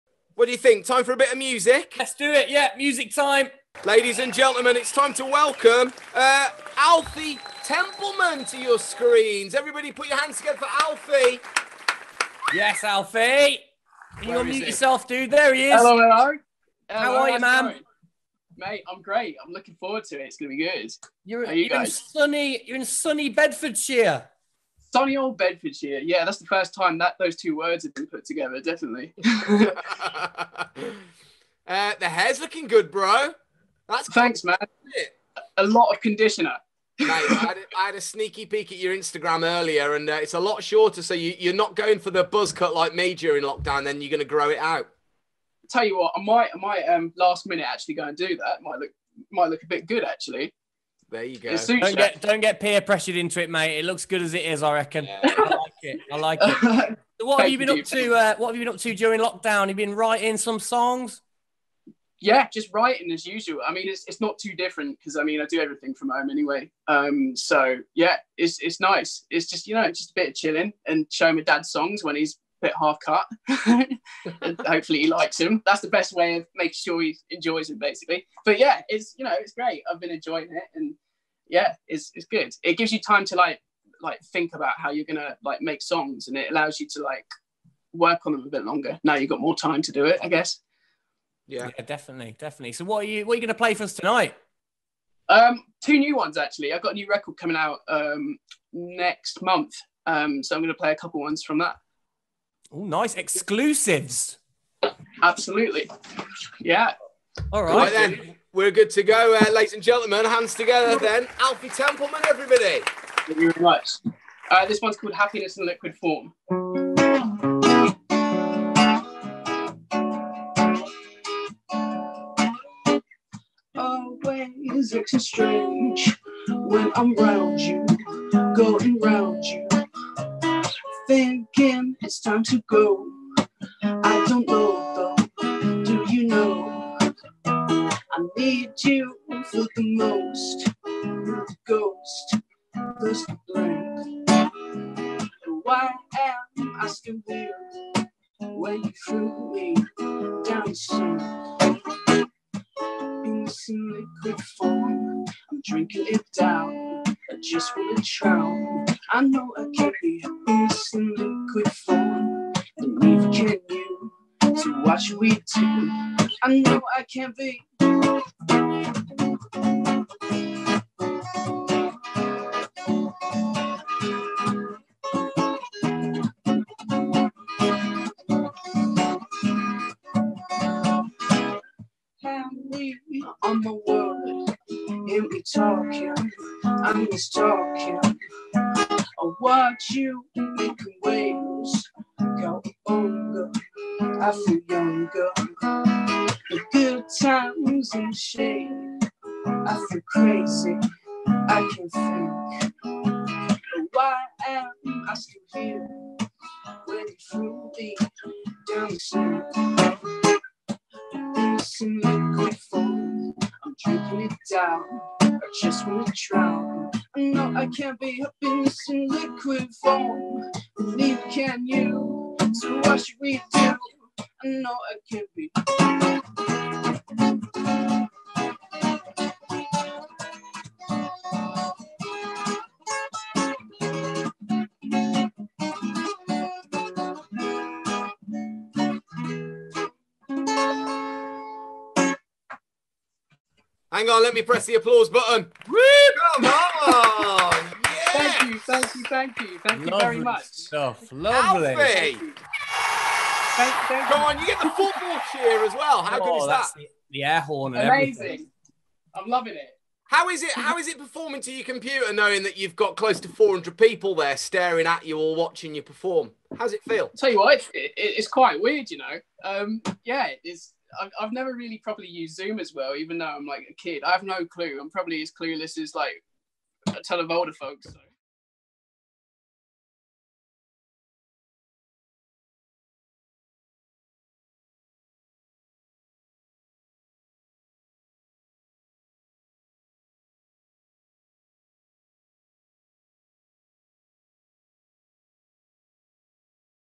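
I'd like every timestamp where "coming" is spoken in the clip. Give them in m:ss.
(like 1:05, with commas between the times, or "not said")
1:37.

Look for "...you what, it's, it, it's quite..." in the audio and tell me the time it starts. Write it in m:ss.
4:27.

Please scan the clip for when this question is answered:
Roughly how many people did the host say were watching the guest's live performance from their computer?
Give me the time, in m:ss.
4:23.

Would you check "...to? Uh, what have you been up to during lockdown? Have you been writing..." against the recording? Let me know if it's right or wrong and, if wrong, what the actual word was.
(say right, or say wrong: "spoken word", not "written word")
right.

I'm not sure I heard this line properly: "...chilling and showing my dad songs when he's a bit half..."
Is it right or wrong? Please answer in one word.
right.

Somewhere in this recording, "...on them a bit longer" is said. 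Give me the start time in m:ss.
1:28.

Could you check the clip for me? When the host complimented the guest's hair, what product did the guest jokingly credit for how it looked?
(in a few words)
Conditioner.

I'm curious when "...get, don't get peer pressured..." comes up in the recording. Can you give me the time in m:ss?
0:51.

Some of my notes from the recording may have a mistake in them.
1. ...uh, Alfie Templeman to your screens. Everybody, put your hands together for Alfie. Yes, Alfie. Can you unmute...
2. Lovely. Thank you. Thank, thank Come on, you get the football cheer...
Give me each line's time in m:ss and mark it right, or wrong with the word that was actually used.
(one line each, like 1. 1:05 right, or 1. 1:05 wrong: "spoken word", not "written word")
1. 0:06 right
2. 4:11 right.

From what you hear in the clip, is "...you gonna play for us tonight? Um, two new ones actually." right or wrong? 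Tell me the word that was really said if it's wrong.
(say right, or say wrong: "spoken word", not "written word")
right.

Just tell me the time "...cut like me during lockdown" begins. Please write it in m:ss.
0:42.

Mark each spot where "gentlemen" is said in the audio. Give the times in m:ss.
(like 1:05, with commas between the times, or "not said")
0:04, 1:49.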